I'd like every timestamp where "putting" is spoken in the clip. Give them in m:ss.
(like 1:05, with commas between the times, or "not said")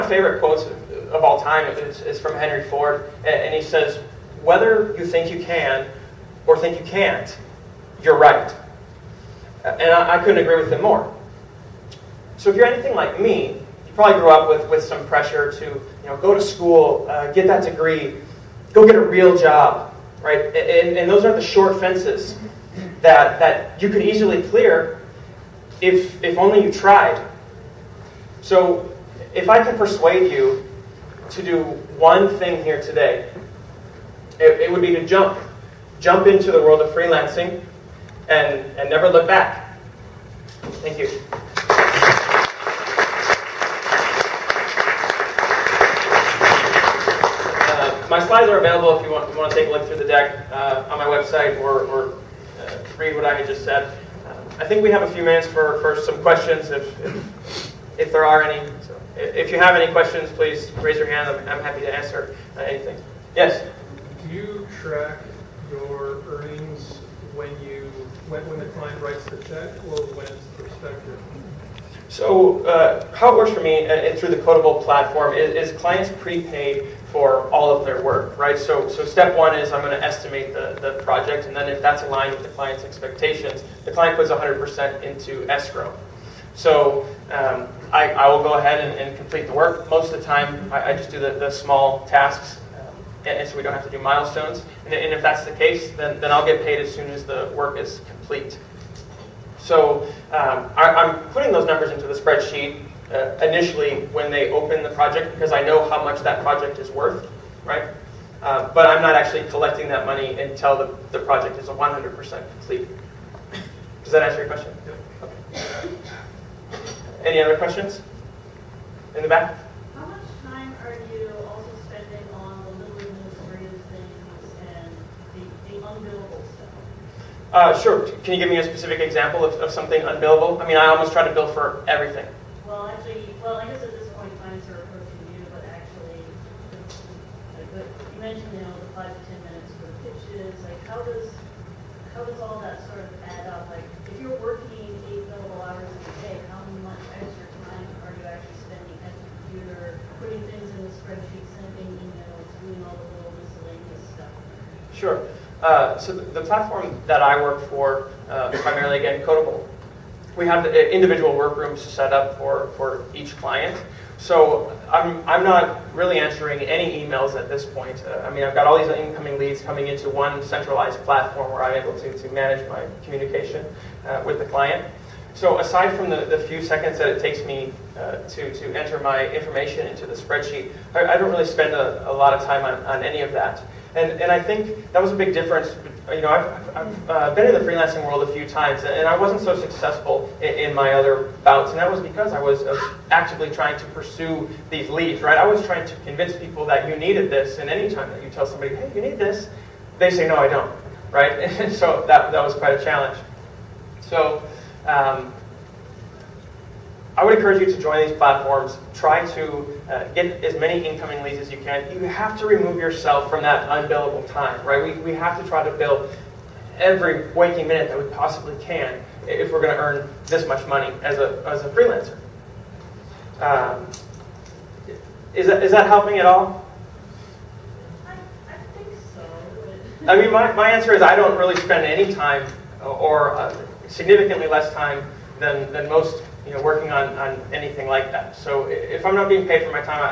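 1:41, 2:30.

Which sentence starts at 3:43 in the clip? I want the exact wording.
Um, is, that, is that helping at all?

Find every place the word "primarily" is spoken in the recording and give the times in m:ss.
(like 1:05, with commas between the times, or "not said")
2:38.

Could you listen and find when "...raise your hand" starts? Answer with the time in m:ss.
1:00.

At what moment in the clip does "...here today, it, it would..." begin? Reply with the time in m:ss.
0:32.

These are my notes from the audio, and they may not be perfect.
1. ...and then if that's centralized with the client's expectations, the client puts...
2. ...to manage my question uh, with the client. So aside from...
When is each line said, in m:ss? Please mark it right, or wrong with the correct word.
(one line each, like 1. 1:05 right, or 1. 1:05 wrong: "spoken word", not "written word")
1. 1:21 wrong: "aligned", not "centralized"
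2. 2:52 wrong: "communication", not "question".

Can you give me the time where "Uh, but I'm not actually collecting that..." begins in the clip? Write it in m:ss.
1:48.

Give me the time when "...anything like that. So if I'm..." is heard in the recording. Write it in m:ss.
3:57.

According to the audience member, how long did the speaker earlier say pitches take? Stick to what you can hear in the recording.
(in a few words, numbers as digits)
5 to 10 minutes.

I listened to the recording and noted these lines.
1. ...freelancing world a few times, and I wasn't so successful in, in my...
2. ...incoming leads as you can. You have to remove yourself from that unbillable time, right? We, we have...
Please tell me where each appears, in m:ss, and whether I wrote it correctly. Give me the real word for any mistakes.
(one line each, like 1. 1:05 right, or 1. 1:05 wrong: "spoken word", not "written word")
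1. 3:07 right
2. 3:30 right.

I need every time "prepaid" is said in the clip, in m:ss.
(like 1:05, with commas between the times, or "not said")
1:16.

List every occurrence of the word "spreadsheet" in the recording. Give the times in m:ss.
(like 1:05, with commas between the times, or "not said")
1:42, 2:31, 3:00.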